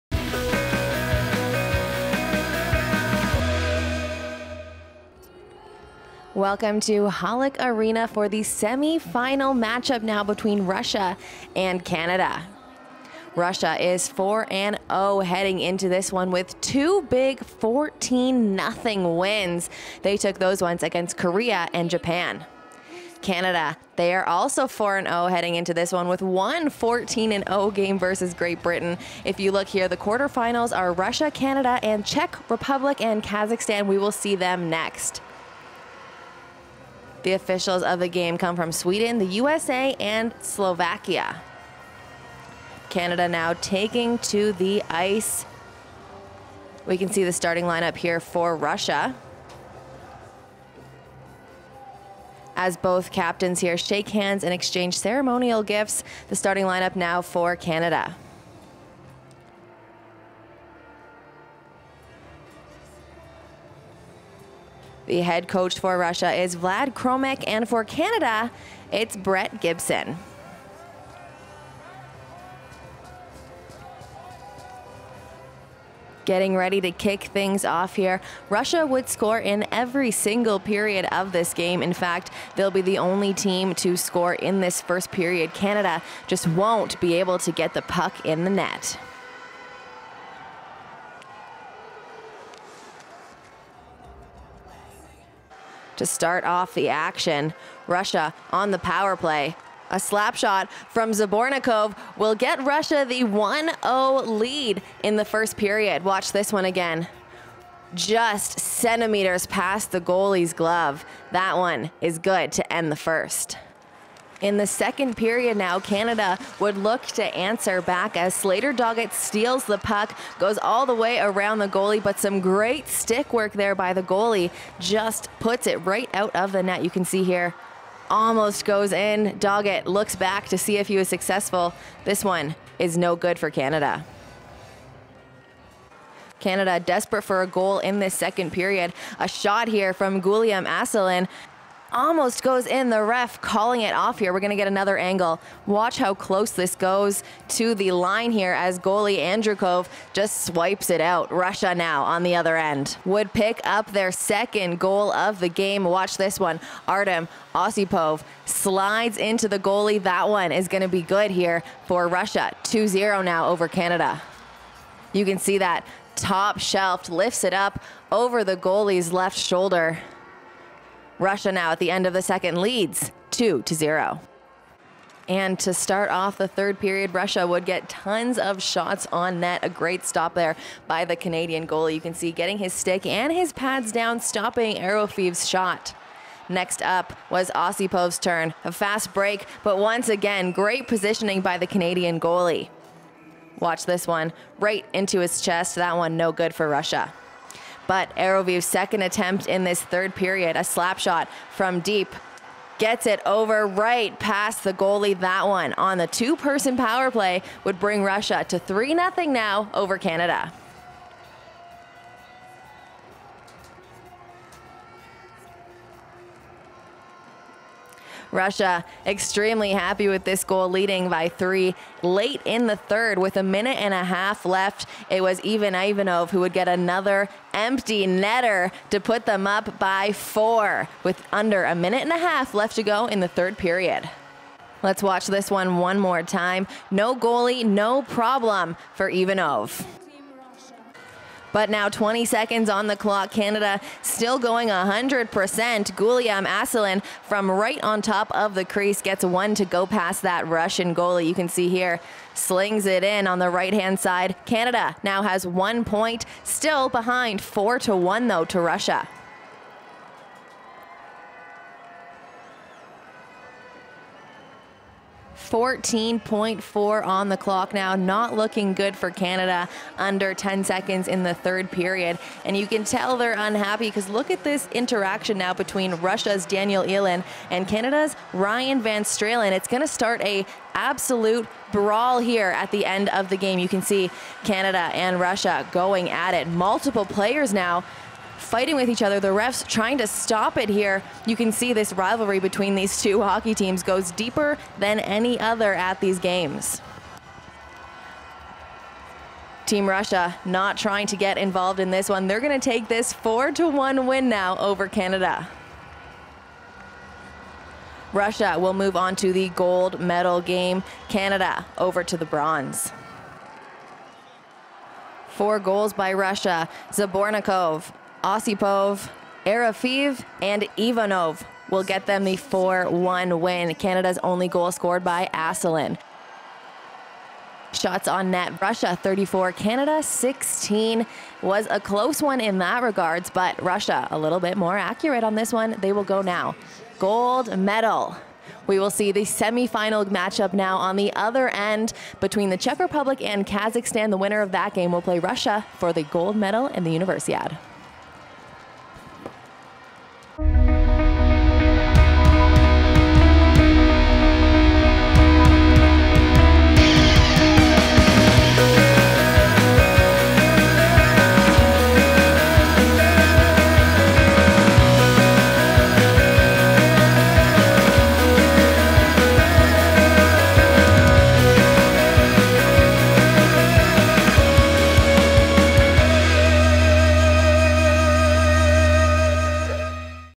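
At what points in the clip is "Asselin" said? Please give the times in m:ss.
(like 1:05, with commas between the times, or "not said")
2:20, 4:06, 5:25.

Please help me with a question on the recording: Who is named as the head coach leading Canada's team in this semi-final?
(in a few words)
Brett Gibson.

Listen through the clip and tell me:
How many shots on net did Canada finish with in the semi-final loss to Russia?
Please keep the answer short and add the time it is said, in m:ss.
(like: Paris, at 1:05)
16, at 5:30.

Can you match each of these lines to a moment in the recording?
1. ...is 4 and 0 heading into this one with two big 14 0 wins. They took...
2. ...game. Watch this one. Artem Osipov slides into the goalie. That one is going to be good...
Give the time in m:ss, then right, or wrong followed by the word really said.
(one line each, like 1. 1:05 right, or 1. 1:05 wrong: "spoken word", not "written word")
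1. 0:13 right
2. 2:35 right.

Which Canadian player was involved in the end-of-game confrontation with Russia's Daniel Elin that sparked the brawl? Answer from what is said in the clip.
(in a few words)
Ryan Van Stralen.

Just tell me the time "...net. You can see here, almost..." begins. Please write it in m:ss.
2:06.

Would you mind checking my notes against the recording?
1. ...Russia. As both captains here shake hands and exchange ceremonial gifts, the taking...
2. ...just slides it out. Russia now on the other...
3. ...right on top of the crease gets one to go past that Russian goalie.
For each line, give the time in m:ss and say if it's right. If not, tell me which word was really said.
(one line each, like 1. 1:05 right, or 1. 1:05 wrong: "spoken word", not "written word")
1. 0:48 wrong: "starting", not "taking"
2. 2:30 wrong: "swipes", not "slides"
3. 4:07 right.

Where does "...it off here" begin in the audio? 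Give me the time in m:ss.
2:23.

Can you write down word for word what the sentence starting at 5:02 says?
They're going to take this 4 to 1 win now over Canada.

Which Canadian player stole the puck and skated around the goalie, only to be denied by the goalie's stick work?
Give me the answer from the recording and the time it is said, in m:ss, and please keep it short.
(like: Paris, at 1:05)
Slater Doggett, at 1:58.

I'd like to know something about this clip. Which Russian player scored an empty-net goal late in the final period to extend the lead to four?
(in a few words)
Ivan Ivanov.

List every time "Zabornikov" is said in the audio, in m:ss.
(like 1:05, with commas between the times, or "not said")
1:41, 5:16.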